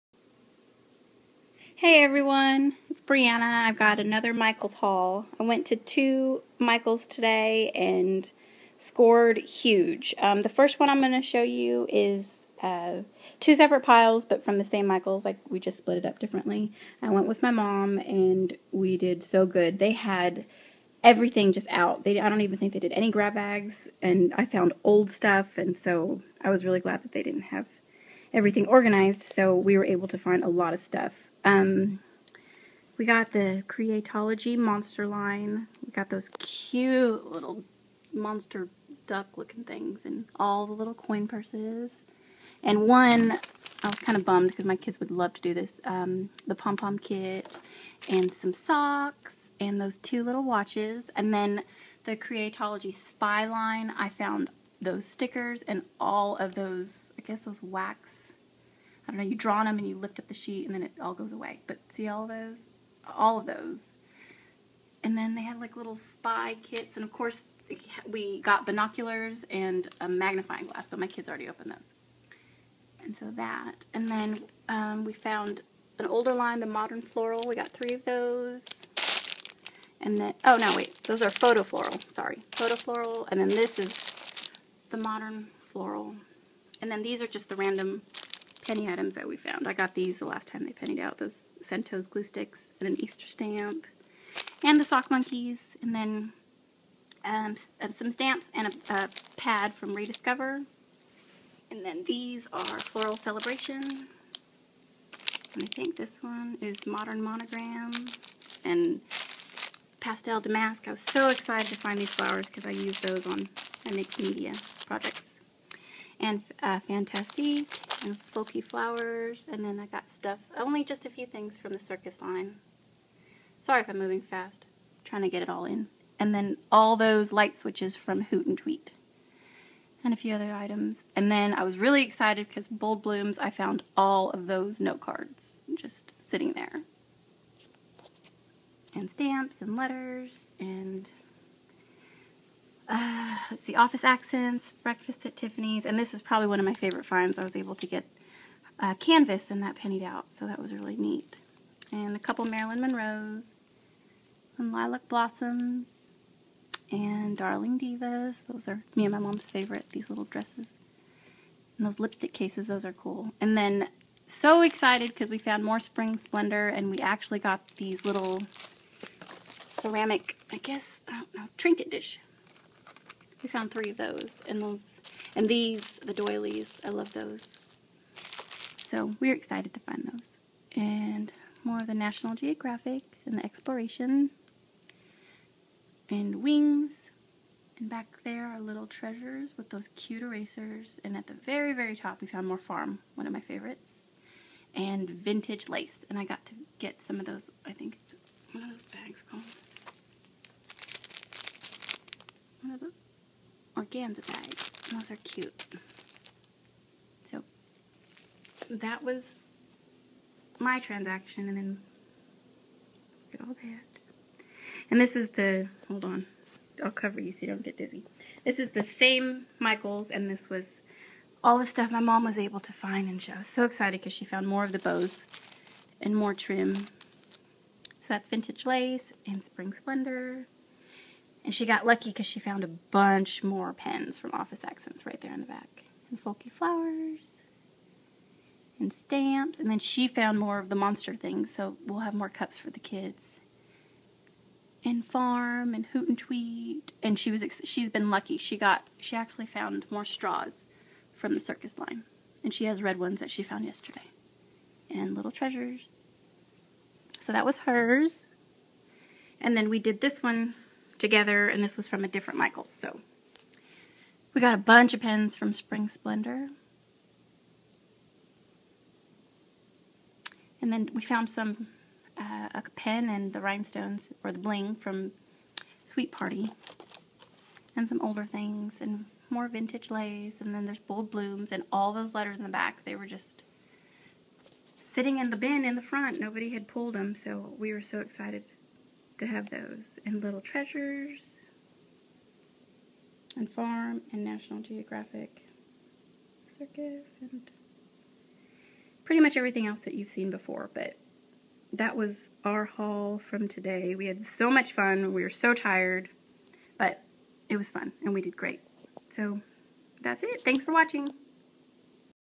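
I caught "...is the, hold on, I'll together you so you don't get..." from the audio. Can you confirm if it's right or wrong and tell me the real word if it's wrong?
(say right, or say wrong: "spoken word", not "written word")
wrong: "cover", not "together".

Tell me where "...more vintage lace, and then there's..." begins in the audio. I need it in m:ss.
4:39.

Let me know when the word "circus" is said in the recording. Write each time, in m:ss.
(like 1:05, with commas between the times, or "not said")
2:01, 4:11, 4:56.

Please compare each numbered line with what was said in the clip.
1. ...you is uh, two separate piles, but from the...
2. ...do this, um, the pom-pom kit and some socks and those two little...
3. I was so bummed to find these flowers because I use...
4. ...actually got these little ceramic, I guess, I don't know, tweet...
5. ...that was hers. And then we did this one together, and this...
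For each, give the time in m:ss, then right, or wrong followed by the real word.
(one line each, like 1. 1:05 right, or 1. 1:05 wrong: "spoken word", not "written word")
1. 0:11 right
2. 0:45 right
3. 1:50 wrong: "excited", not "bummed"
4. 2:46 wrong: "trinket", not "tweet"
5. 4:17 right.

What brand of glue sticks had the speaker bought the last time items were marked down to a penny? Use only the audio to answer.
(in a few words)
Centos.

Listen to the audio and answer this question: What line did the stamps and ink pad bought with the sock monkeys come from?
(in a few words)
Rediscover.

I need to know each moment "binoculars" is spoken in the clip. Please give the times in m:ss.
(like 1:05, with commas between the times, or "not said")
1:08.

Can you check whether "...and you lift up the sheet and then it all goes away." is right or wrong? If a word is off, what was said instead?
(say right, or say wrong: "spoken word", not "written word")
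right.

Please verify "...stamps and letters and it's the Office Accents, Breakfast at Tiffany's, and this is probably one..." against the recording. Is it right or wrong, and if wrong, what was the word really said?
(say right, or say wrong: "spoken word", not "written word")
right.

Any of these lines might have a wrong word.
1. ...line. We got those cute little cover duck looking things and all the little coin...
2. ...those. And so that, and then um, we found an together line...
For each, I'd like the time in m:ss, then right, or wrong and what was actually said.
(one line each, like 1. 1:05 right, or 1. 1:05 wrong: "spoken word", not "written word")
1. 0:35 wrong: "monster", not "cover"
2. 1:11 wrong: "older", not "together".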